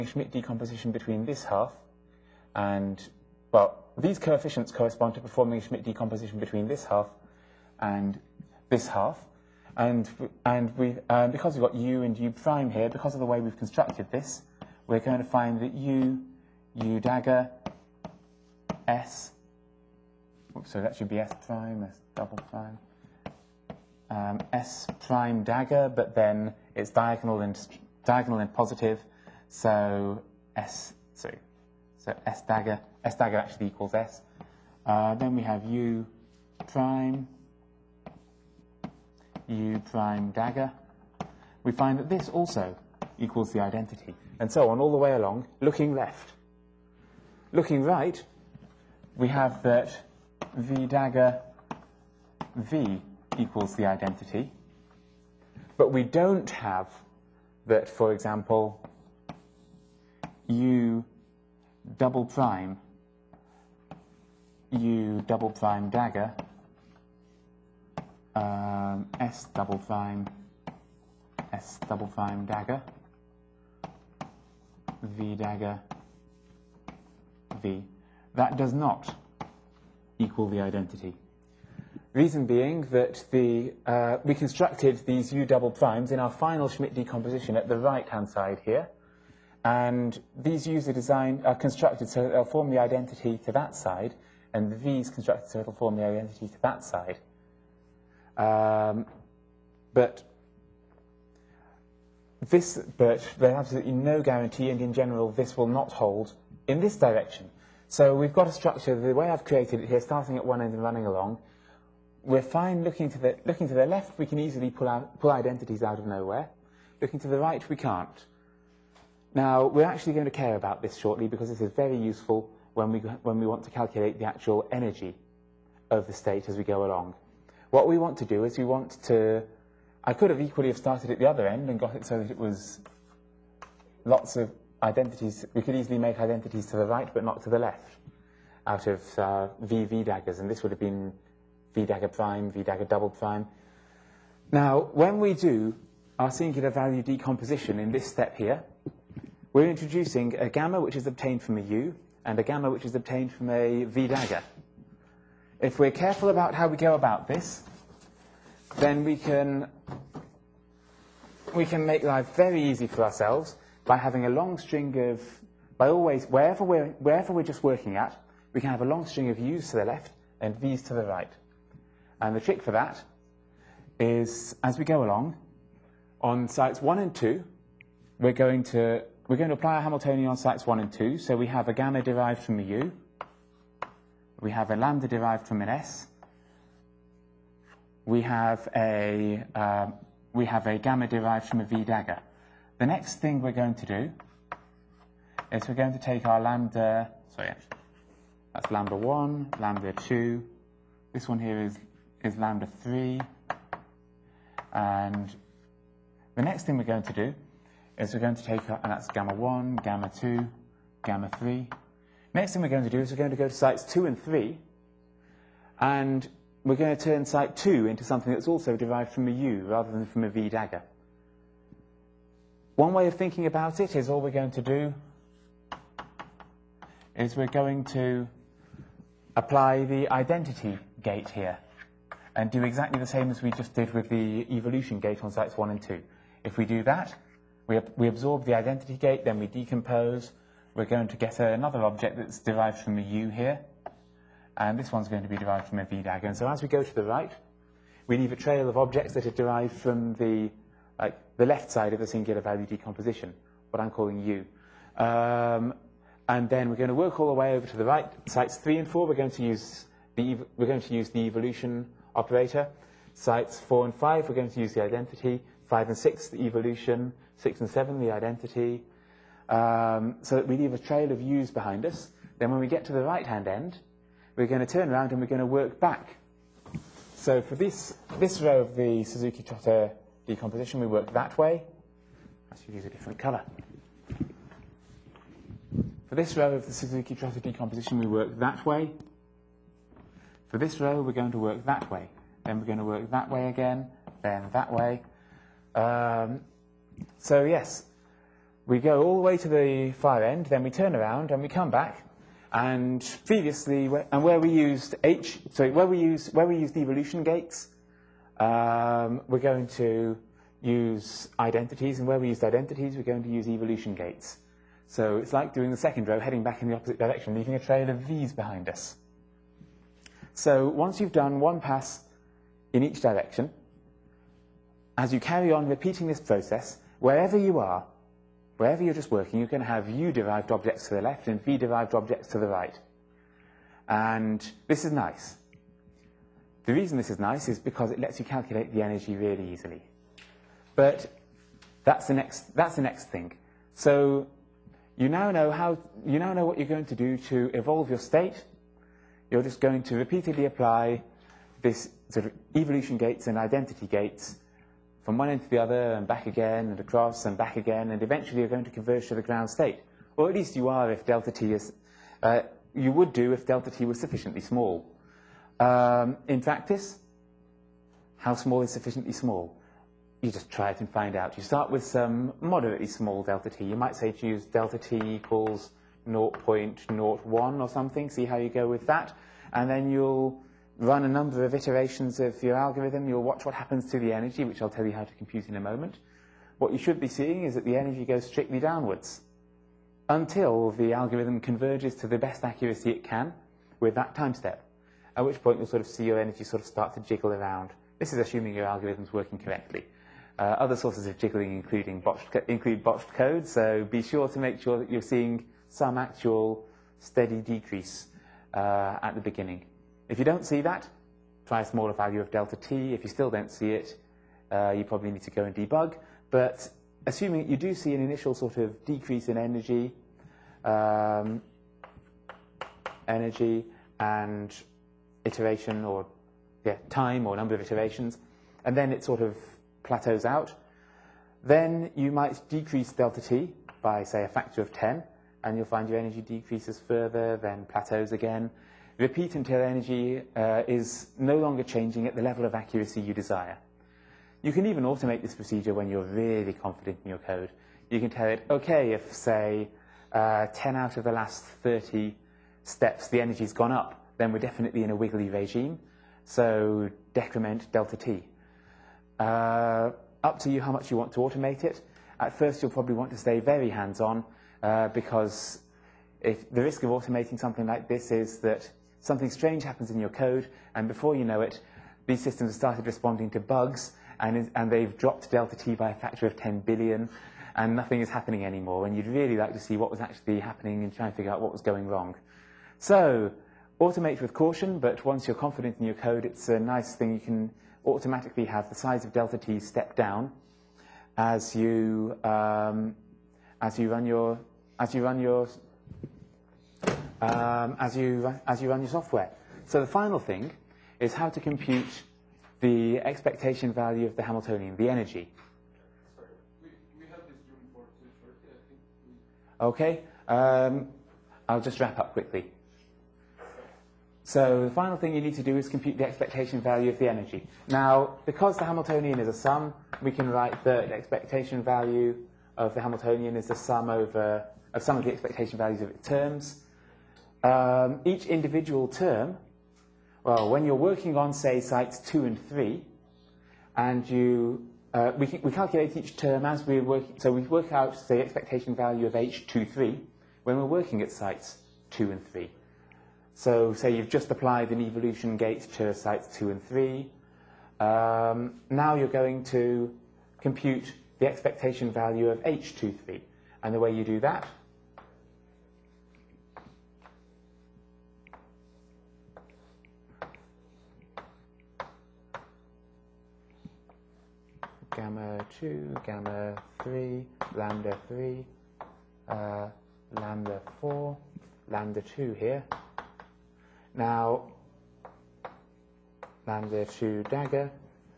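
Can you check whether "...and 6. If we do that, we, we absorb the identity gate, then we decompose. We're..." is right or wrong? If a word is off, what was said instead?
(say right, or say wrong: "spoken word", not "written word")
wrong: "2", not "6".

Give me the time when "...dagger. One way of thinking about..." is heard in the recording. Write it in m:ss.
3:40.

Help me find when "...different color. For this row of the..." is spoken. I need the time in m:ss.
4:42.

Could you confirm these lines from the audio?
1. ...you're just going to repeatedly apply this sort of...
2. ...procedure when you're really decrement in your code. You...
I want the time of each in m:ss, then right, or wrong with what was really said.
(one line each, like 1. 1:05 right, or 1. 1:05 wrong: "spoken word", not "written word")
1. 5:49 right
2. 7:25 wrong: "confident", not "decrement".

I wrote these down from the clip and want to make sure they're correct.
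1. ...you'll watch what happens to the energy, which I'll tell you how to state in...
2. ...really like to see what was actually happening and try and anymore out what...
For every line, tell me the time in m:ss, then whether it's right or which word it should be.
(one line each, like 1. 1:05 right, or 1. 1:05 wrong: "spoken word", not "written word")
1. 6:23 wrong: "compute", not "state"
2. 7:59 wrong: "figure", not "anymore".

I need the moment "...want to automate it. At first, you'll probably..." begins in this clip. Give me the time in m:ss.
7:40.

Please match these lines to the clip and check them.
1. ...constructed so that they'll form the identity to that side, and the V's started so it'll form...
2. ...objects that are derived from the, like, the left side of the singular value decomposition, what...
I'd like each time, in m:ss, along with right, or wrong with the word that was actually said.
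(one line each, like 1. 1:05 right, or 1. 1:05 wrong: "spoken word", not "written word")
1. 1:31 wrong: "constructed", not "started"
2. 4:08 right.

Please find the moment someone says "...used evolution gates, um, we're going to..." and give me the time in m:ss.
5:06.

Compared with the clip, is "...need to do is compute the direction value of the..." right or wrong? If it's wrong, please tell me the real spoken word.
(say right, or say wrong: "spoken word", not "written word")
wrong: "expectation", not "direction".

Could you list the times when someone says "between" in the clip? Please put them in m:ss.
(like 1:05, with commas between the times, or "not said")
0:00, 0:06.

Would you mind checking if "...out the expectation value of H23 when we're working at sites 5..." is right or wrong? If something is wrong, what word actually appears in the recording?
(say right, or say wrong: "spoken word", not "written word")
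wrong: "2", not "5".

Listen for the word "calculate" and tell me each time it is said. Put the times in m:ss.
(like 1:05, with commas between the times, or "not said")
2:03, 5:38, 8:55.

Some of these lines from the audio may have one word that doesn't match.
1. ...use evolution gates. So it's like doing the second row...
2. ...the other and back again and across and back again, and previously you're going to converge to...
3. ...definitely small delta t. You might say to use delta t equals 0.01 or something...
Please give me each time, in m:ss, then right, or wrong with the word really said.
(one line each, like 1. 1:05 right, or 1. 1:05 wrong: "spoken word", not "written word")
1. 5:13 right
2. 5:55 wrong: "eventually", not "previously"
3. 6:12 wrong: "moderately", not "definitely".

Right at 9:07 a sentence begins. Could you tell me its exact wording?
Um, now you're going to compute the expectation value of H23.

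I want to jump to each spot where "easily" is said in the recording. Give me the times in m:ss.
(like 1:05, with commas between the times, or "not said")
1:54, 2:15, 5:39.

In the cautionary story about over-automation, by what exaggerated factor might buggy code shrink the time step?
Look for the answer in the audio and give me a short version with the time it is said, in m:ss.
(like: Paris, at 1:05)
10 billion, at 7:55.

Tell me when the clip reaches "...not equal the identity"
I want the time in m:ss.
1:18.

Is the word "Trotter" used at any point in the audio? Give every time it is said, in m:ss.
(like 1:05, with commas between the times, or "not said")
4:39, 4:47.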